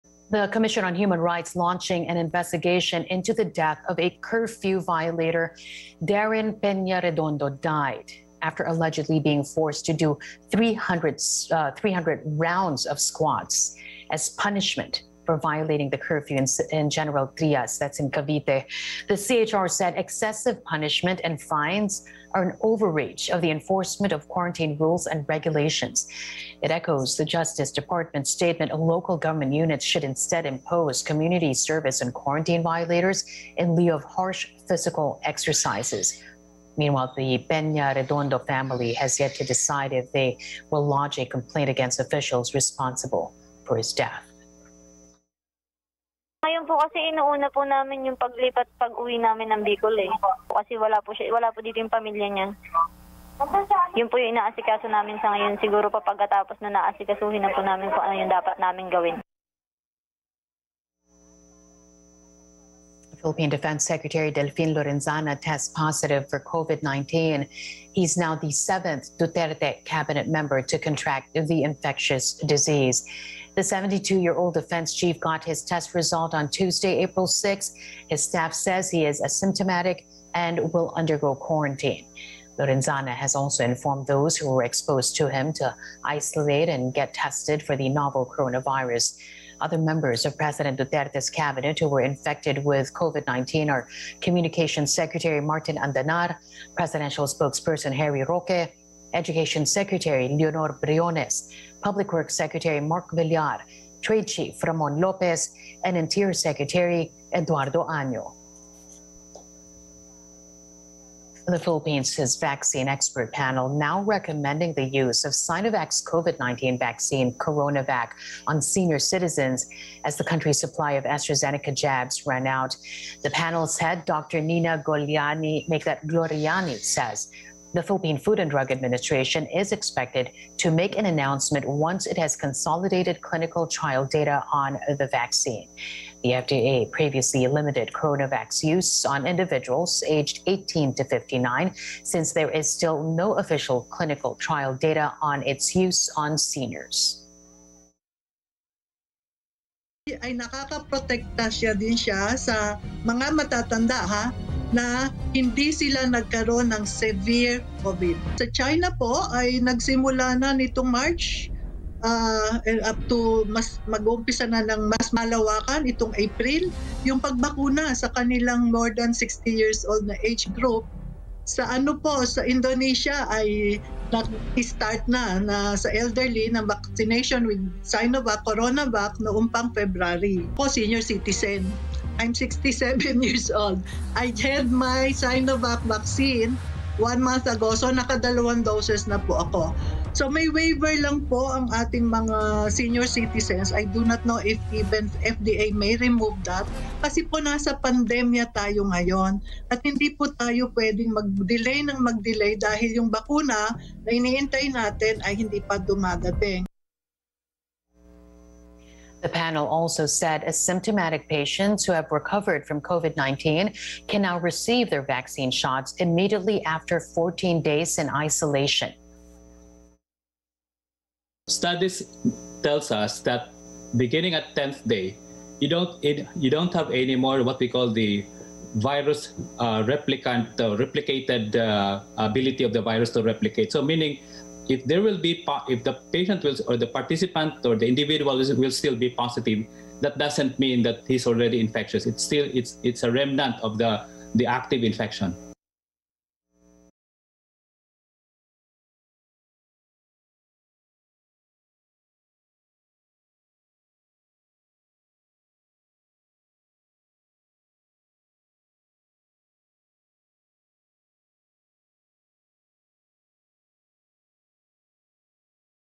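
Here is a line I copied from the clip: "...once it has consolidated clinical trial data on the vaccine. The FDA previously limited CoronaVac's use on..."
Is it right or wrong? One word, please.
right.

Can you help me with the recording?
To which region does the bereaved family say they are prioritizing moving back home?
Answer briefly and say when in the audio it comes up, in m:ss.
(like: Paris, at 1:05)
Bicol, at 0:49.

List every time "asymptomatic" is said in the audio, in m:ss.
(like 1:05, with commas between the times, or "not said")
1:19, 3:30.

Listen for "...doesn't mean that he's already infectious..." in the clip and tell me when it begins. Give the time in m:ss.
4:00.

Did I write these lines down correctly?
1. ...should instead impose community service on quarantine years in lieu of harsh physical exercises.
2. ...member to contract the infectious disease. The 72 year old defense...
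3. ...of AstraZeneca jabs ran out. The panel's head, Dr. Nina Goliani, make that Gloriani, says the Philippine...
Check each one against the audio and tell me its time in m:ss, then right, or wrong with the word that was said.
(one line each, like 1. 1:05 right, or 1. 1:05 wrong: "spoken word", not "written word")
1. 0:29 wrong: "violators", not "years"
2. 1:10 right
3. 2:00 right.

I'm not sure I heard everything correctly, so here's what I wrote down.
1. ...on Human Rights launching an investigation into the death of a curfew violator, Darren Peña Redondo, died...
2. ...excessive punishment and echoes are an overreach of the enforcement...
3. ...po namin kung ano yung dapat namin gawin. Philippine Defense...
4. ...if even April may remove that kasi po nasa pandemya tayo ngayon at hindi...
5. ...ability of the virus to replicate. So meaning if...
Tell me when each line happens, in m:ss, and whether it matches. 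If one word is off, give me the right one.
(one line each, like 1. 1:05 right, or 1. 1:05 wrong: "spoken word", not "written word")
1. 0:00 right
2. 0:19 wrong: "fines", not "echoes"
3. 0:57 right
4. 3:14 wrong: "FDA", not "April"
5. 3:52 right.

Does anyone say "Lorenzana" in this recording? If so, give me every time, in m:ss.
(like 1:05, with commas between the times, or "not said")
1:04, 1:22.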